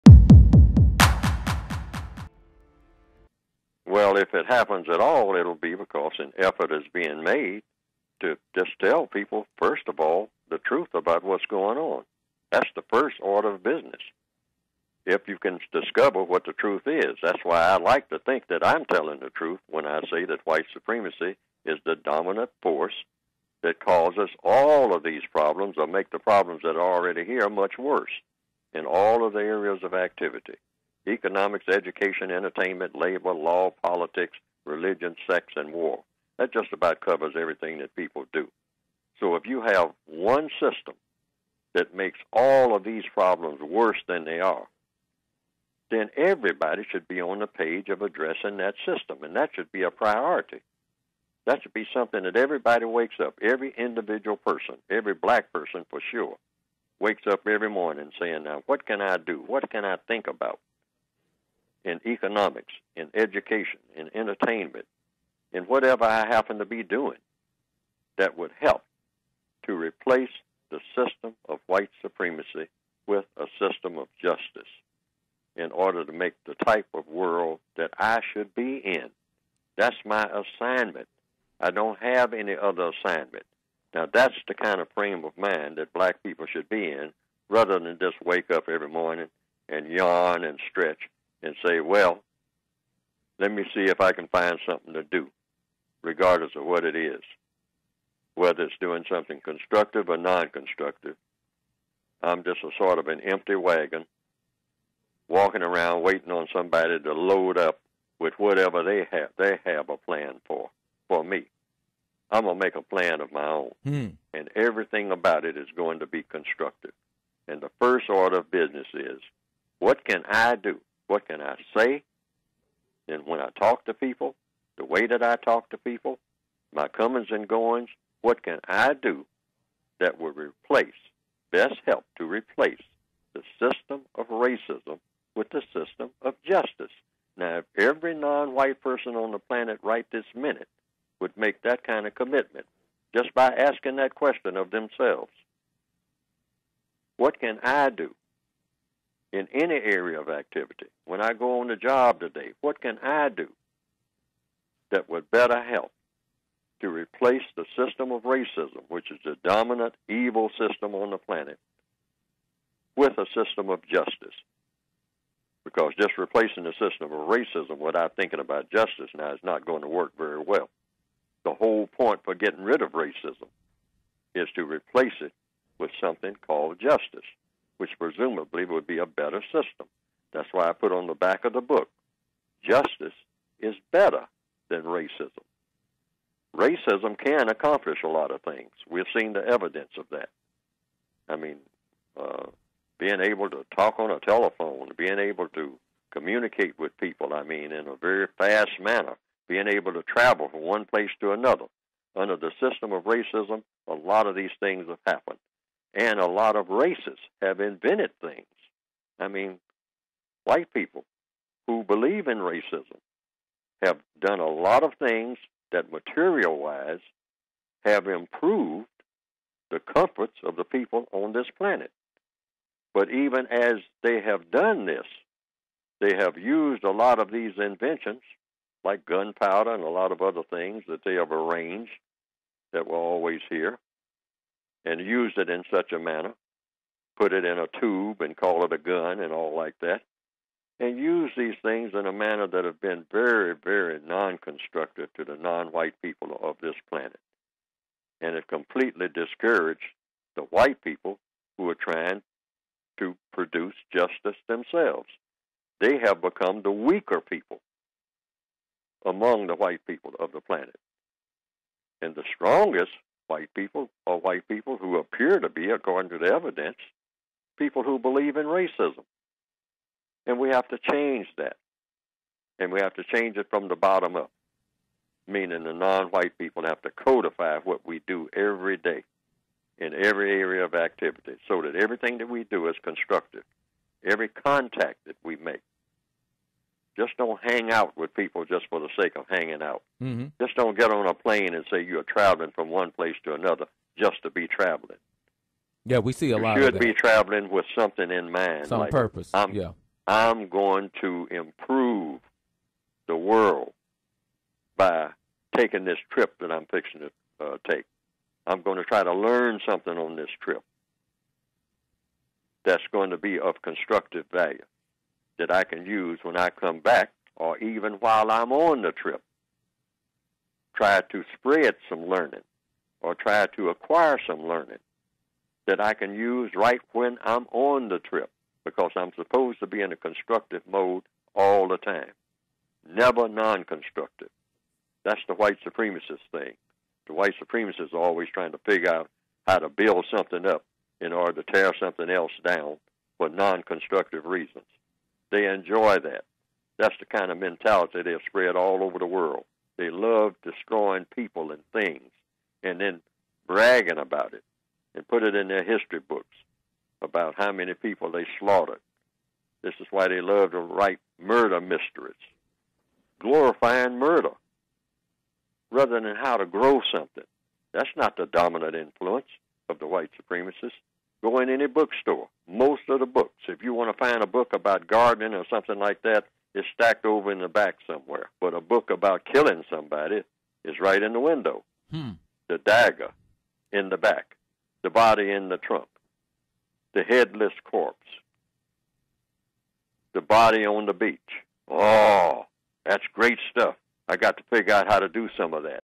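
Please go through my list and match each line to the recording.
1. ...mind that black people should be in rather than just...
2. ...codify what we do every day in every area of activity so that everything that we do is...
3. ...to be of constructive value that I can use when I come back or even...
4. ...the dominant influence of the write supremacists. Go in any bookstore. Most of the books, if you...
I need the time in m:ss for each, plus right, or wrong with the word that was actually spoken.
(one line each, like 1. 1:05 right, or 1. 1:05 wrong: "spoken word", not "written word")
1. 1:25 right
2. 4:36 right
3. 5:13 right
4. 6:08 wrong: "white", not "write".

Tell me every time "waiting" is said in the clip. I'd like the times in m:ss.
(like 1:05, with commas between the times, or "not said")
1:46.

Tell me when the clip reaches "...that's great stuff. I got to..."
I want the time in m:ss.
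6:32.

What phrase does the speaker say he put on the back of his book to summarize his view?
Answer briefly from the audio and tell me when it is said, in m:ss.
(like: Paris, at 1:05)
Justice is better than racism, at 3:02.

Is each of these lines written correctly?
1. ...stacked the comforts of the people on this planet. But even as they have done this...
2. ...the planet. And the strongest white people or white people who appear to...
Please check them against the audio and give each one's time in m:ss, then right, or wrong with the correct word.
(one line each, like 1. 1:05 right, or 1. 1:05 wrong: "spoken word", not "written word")
1. 3:38 wrong: "improved", not "stacked"
2. 4:20 right.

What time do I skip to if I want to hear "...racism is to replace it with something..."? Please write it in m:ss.
2:52.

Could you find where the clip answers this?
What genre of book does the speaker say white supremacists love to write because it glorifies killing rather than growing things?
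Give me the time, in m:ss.
6:01.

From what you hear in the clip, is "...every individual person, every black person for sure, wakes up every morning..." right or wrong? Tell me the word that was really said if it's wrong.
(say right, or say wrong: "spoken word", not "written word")
right.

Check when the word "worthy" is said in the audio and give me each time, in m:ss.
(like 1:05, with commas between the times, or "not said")
not said.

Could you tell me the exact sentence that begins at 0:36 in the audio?
That just about covers everything that people do.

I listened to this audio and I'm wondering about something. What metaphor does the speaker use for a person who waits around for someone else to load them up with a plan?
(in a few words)
An empty wagon.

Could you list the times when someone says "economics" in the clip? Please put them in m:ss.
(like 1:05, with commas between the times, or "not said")
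0:31, 1:02.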